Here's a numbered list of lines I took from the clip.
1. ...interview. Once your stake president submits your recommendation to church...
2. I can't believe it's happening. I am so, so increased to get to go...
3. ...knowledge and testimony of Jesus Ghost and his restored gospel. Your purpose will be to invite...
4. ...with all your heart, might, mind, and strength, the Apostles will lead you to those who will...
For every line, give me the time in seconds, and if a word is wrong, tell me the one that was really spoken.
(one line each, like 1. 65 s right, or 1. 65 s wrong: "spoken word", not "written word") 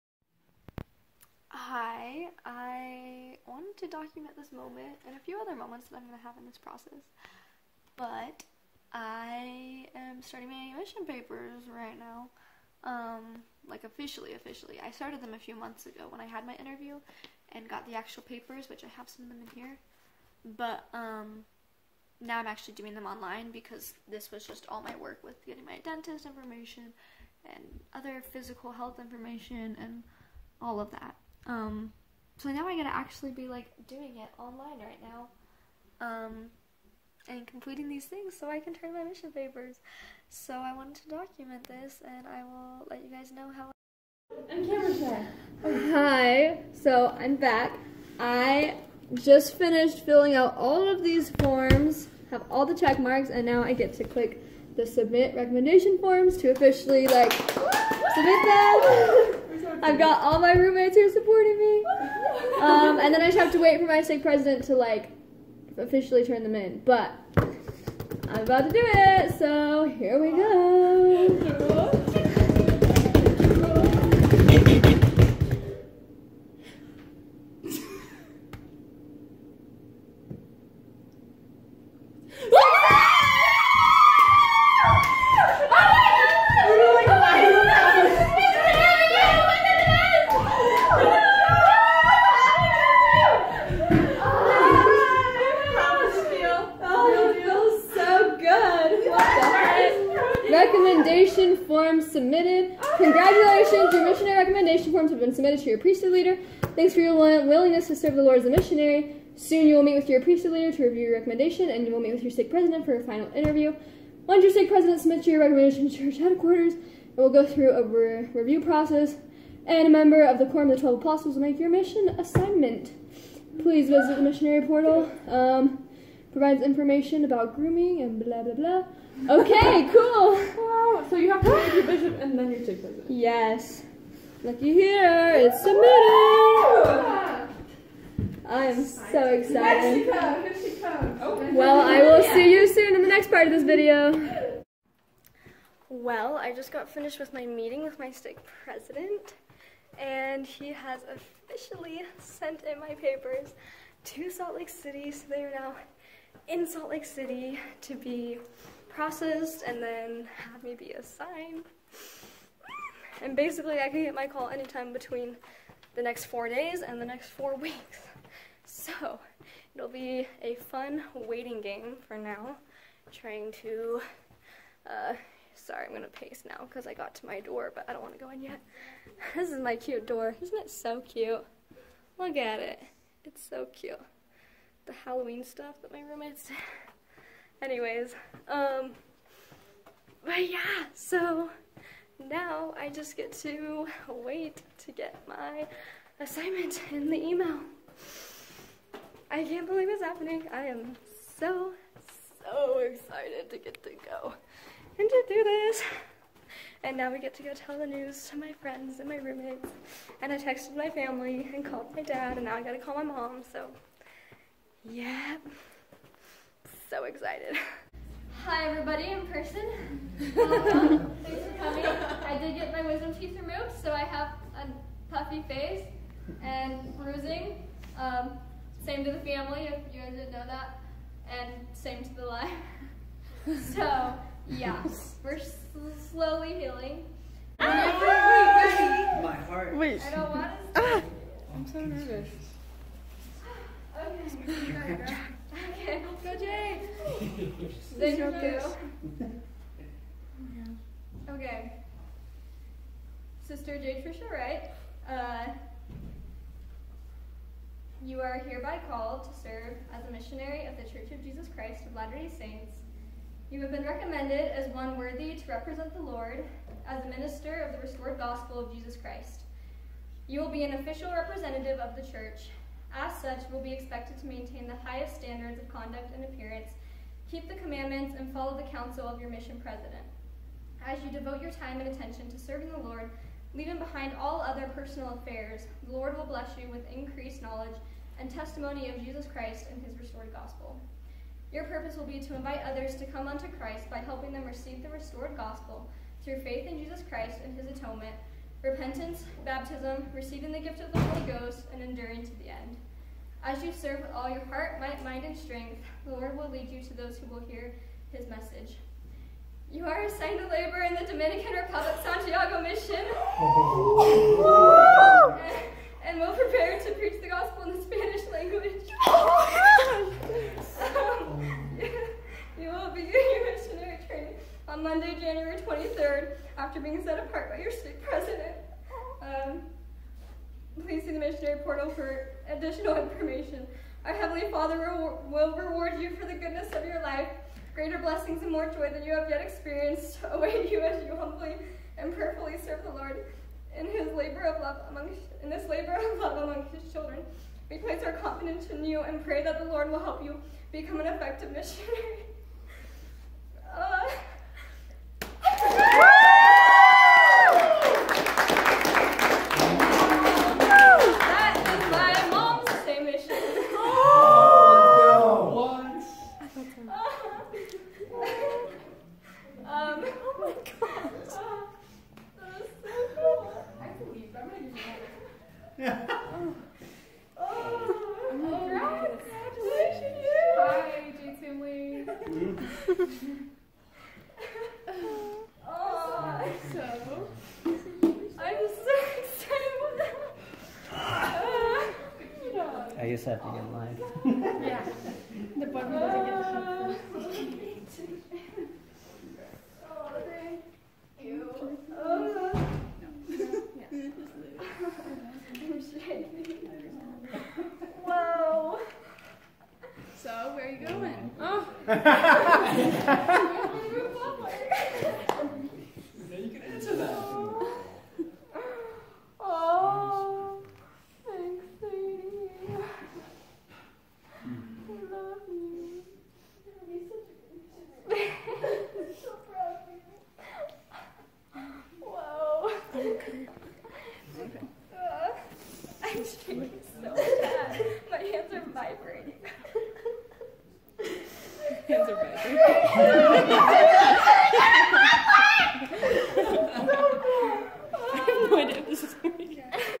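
1. 113 s right
2. 199 s wrong: "excited", not "increased"
3. 287 s wrong: "Christ", not "Ghost"
4. 304 s wrong: "Lord", not "Apostles".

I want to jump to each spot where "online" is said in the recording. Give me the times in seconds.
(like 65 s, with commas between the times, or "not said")
23 s, 34 s.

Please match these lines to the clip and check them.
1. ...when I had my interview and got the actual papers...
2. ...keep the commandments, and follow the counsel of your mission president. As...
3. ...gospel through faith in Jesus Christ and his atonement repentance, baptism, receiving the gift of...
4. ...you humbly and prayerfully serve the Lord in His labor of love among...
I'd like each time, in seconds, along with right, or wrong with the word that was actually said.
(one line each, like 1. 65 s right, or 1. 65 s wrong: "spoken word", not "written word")
1. 16 s right
2. 277 s right
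3. 295 s right
4. 341 s right.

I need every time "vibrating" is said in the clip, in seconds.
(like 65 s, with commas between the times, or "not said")
438 s, 443 s.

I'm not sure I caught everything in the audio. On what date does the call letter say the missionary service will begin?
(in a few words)
Monday, January 23rd.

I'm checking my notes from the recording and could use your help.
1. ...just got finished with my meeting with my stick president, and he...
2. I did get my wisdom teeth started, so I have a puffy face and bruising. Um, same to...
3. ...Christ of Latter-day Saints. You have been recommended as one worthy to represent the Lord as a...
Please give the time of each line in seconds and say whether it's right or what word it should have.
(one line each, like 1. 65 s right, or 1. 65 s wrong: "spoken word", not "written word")
1. 146 s right
2. 222 s wrong: "removed", not "started"
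3. 261 s right.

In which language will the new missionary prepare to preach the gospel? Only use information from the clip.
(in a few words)
Spanish.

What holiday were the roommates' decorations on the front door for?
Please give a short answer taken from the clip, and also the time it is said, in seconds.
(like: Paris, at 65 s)
Halloween, at 185 s.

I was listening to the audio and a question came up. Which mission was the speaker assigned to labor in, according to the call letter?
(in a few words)
Dominican Republic Santiago Mission.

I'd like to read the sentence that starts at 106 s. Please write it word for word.
Thanks for your willingness to serve the Lord as a missionary.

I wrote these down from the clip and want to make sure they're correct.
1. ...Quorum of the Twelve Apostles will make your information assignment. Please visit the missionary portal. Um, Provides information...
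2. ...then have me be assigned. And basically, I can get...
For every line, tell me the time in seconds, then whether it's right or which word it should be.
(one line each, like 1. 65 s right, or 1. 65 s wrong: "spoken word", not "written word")
1. 120 s wrong: "mission", not "information"
2. 159 s right.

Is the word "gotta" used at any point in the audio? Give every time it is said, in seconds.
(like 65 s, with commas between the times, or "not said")
32 s, 212 s.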